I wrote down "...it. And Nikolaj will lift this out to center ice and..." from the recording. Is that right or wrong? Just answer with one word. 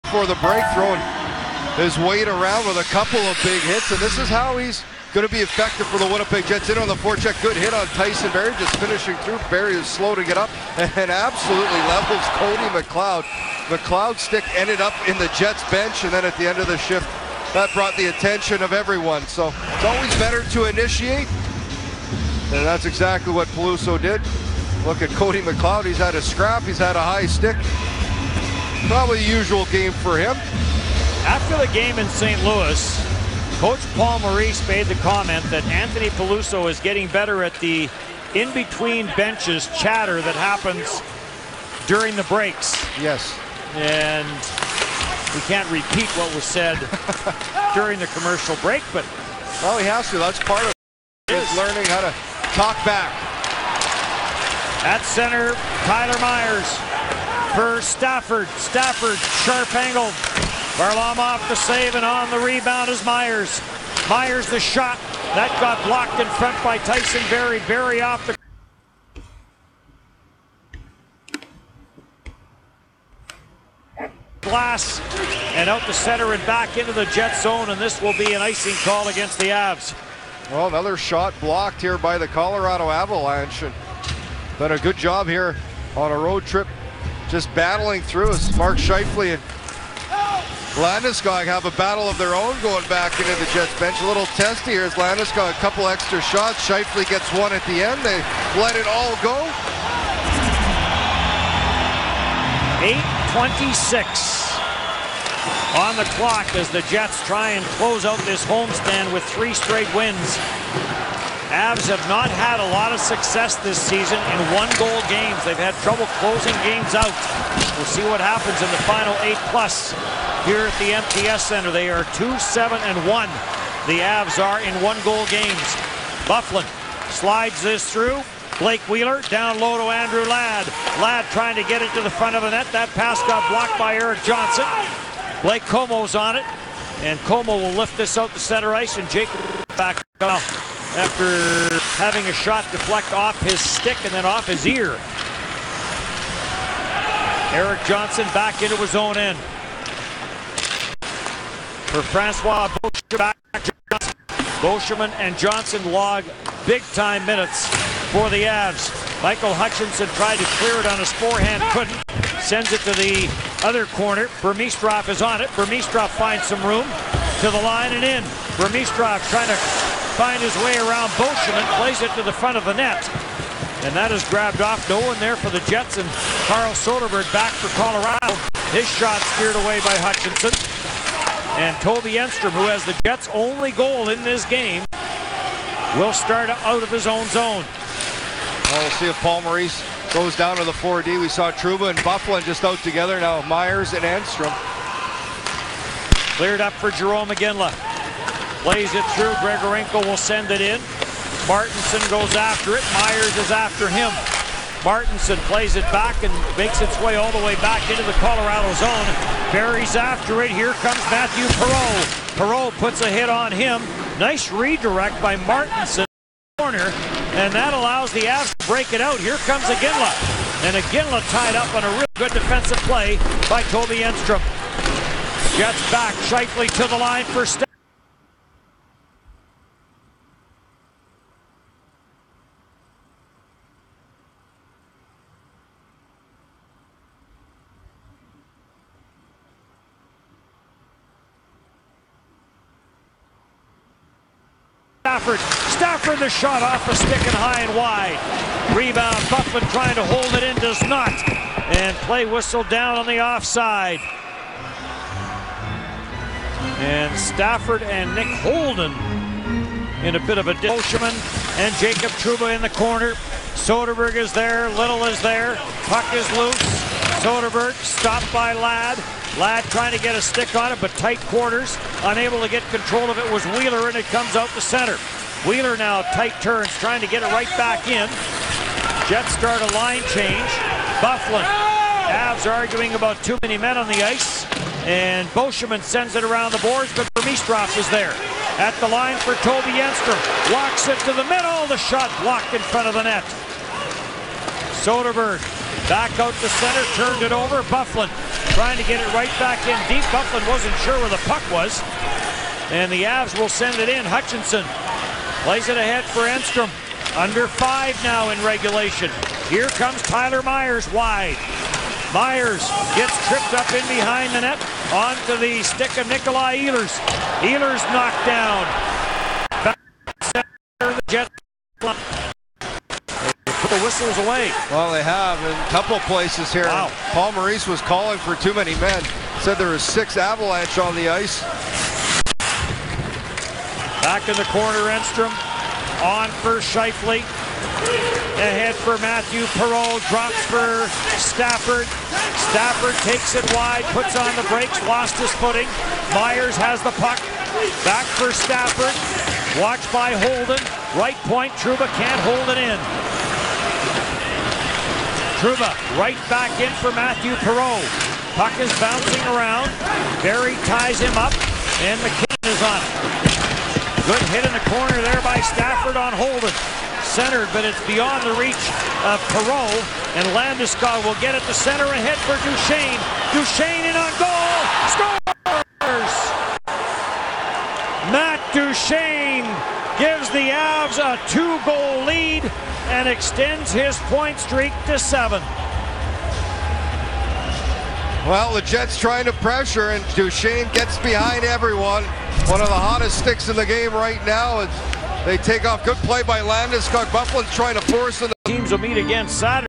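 wrong.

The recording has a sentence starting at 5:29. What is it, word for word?
Said there was six avalanche on the ice.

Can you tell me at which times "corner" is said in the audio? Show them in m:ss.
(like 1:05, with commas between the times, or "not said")
2:43, 3:36, 4:22, 5:34, 6:04.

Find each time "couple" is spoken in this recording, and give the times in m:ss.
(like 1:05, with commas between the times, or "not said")
0:02, 1:35, 5:25.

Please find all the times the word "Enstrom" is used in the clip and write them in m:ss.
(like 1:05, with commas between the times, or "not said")
3:02, 3:14, 3:44, 4:49, 5:06, 5:34.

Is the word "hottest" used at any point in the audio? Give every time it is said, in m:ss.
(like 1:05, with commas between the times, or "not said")
6:32.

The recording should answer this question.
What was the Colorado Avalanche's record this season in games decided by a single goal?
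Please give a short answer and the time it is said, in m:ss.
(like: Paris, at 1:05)
2-7-1, at 2:02.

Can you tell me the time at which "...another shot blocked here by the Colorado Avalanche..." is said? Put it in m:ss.
1:20.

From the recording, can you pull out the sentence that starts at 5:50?
Right point, Trouba can't hold it in.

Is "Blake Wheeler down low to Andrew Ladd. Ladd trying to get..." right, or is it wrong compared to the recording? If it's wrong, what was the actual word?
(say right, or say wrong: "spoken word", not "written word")
right.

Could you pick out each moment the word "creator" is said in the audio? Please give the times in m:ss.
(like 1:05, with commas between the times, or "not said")
not said.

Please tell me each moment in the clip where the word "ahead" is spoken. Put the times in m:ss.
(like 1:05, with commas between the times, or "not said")
5:05, 5:38, 6:11.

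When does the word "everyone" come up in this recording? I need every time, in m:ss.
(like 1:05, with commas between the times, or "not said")
0:18, 6:31.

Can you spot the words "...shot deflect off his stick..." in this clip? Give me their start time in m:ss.
2:22.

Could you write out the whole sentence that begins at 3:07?
Well, we'll see if Paul Maurice goes down to the 4D.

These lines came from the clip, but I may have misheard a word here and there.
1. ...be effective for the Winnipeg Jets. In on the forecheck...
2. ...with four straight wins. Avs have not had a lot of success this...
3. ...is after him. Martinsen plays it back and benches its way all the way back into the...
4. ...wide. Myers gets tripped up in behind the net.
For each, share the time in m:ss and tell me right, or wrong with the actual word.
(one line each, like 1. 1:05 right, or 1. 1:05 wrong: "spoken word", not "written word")
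1. 0:05 right
2. 1:49 wrong: "three", not "four"
3. 3:23 wrong: "makes", not "benches"
4. 5:10 right.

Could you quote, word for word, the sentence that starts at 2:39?
Michael Hutchinson tried to clear it on his forehand, couldn't.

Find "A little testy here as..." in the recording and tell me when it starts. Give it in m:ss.
1:34.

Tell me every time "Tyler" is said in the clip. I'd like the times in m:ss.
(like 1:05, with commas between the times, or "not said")
0:55, 5:10.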